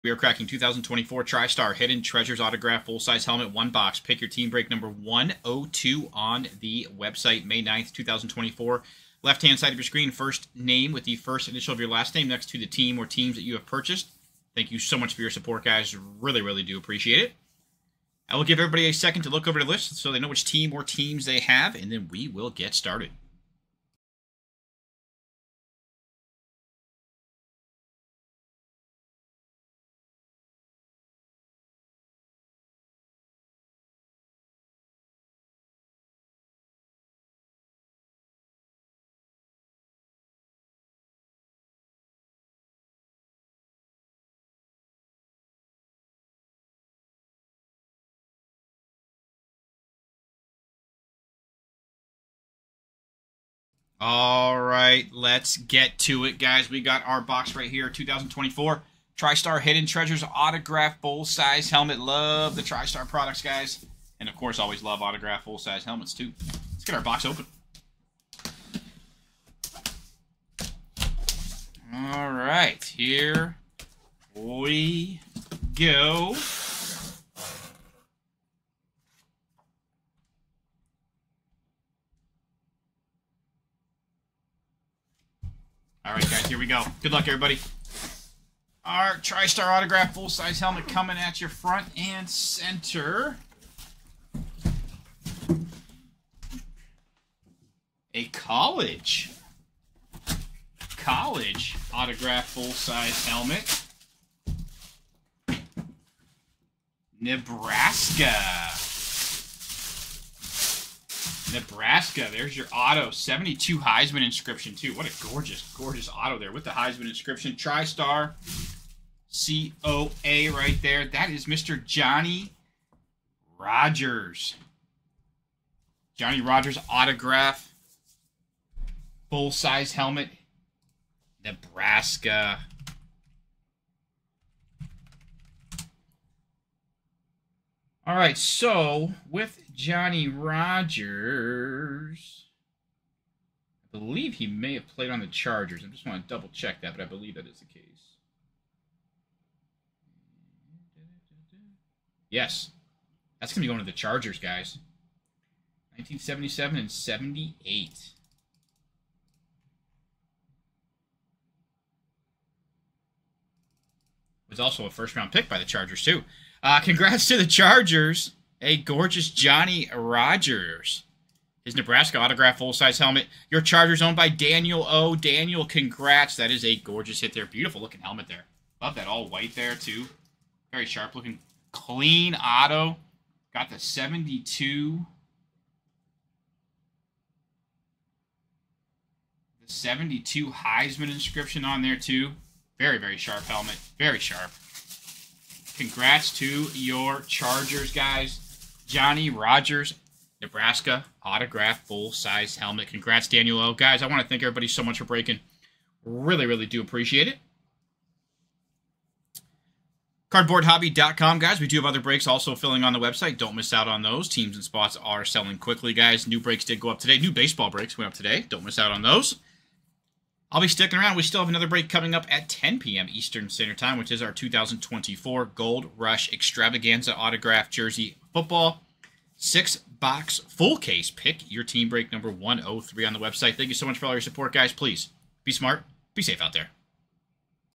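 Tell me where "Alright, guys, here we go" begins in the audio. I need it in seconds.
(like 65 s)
86 s.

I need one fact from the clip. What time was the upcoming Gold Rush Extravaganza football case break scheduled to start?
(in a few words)
10 p.m. Eastern.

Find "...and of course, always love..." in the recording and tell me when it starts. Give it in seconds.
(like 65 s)
64 s.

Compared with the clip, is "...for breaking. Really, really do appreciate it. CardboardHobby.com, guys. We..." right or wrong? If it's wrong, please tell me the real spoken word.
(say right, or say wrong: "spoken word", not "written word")
right.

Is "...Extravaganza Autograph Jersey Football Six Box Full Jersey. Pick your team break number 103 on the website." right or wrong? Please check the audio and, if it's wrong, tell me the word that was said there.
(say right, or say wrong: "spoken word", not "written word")
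wrong: "Case", not "Jersey".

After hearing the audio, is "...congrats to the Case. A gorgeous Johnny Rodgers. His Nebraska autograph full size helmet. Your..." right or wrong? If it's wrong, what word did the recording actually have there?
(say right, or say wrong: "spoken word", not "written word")
wrong: "Chargers", not "Case".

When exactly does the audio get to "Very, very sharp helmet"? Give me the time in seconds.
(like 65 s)
192 s.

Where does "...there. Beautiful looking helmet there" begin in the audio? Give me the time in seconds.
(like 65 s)
177 s.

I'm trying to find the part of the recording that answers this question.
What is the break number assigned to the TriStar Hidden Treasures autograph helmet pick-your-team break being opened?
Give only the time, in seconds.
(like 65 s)
4 s.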